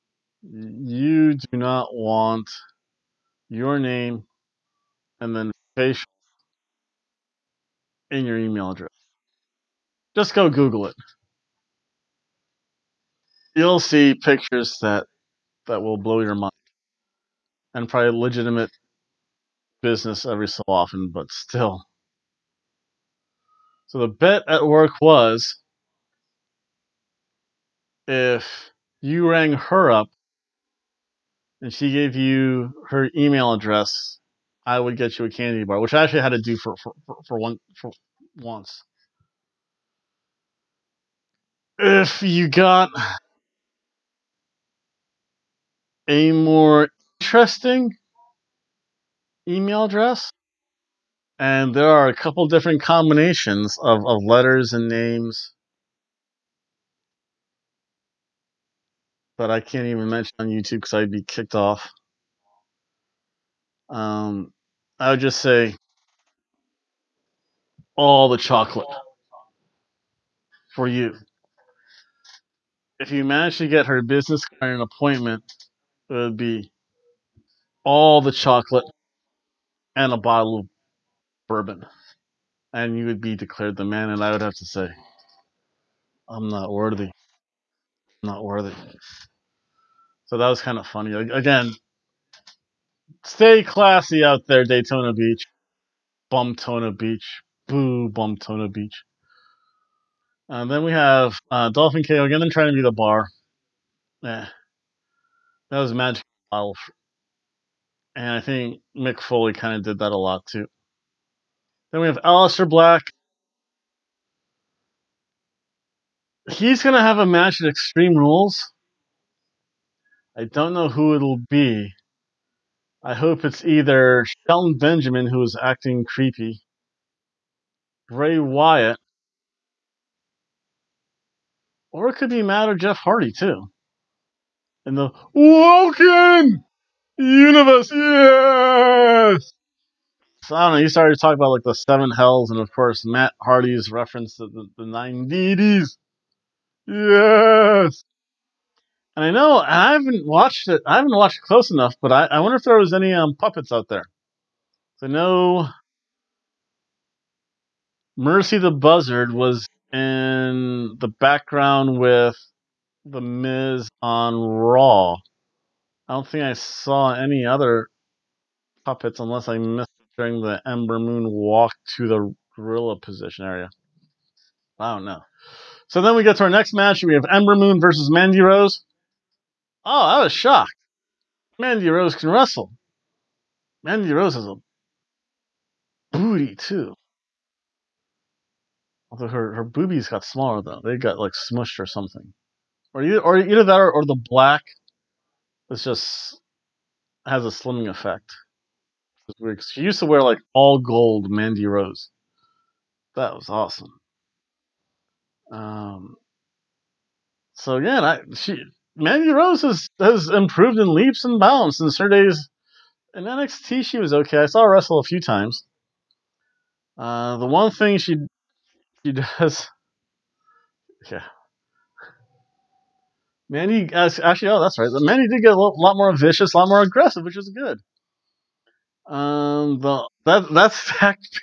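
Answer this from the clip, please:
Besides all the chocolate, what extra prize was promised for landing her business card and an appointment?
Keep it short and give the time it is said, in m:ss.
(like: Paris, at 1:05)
bottle of bourbon, at 1:20.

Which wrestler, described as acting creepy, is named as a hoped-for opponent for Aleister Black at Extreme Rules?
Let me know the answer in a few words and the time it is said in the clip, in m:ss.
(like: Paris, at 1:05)
Shelton Benjamin, at 2:04.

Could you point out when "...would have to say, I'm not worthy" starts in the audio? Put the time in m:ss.
1:24.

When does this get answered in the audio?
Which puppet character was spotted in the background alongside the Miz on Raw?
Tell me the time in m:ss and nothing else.
2:38.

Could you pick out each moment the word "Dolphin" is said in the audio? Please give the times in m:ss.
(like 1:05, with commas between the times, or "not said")
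1:41.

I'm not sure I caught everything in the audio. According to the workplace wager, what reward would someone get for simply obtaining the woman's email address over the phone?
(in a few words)
candy bar.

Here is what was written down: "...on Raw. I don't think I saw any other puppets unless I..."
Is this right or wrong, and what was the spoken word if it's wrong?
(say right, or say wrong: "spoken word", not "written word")
right.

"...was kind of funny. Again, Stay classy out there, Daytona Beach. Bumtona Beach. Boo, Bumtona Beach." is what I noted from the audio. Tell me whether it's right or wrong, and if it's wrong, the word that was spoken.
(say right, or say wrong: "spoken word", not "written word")
right.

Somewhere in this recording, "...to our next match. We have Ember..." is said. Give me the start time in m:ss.
2:56.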